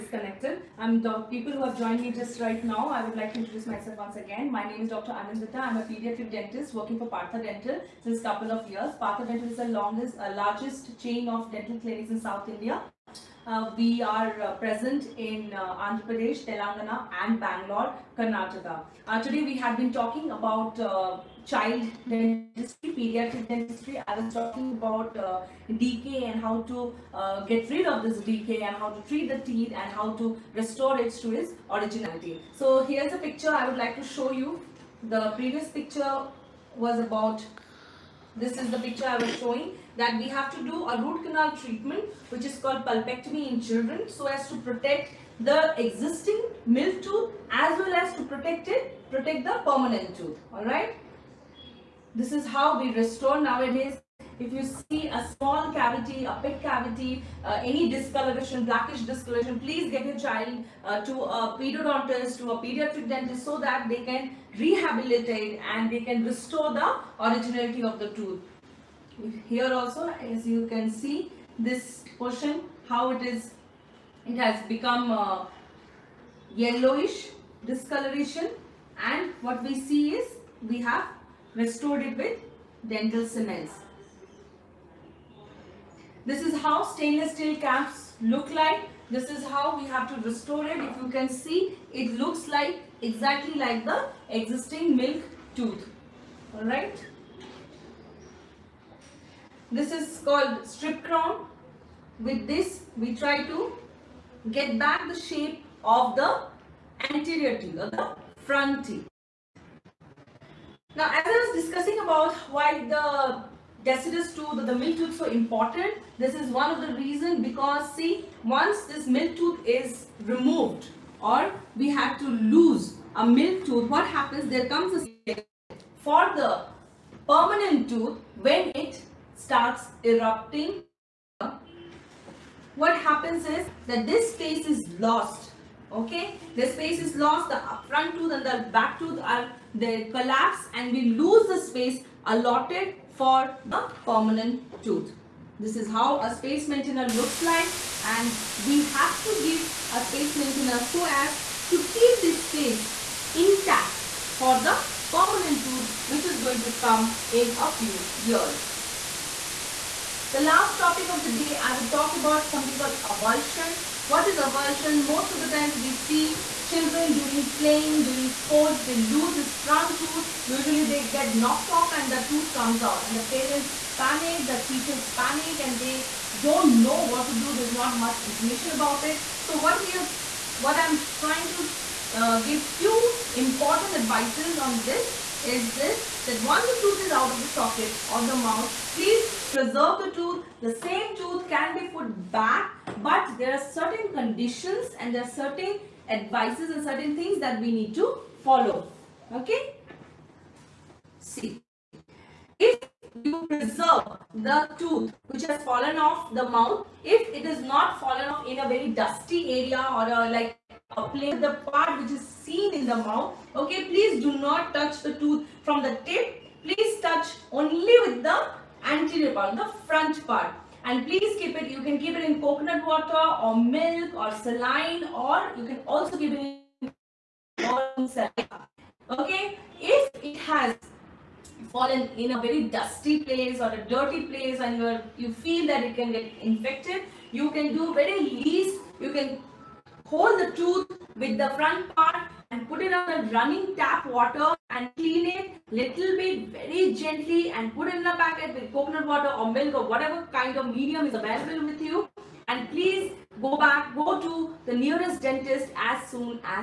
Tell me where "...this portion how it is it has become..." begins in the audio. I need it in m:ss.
1:11.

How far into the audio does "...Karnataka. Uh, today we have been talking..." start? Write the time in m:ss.
0:18.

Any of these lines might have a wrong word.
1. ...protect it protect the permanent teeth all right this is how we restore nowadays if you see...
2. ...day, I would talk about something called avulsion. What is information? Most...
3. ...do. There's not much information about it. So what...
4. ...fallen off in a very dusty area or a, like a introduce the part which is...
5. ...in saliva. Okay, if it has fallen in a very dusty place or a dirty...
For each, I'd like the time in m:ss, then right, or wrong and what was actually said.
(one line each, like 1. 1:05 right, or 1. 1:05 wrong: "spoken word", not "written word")
1. 0:48 wrong: "tooth", not "teeth"
2. 2:41 wrong: "avulsion", not "information"
3. 2:57 right
4. 3:28 wrong: "place", not "introduce"
5. 3:47 right.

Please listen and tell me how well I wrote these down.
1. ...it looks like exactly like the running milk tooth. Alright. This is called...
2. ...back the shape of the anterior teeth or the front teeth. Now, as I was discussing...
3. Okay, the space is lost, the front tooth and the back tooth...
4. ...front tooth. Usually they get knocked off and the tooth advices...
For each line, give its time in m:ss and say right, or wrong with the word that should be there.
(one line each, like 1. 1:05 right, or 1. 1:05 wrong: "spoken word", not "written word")
1. 1:31 wrong: "existing", not "running"
2. 1:44 right
3. 2:15 right
4. 2:49 wrong: "comes", not "advices".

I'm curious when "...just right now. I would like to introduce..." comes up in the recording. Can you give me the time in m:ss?
0:02.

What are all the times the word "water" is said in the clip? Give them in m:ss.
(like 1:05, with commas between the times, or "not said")
3:42, 4:04, 4:09.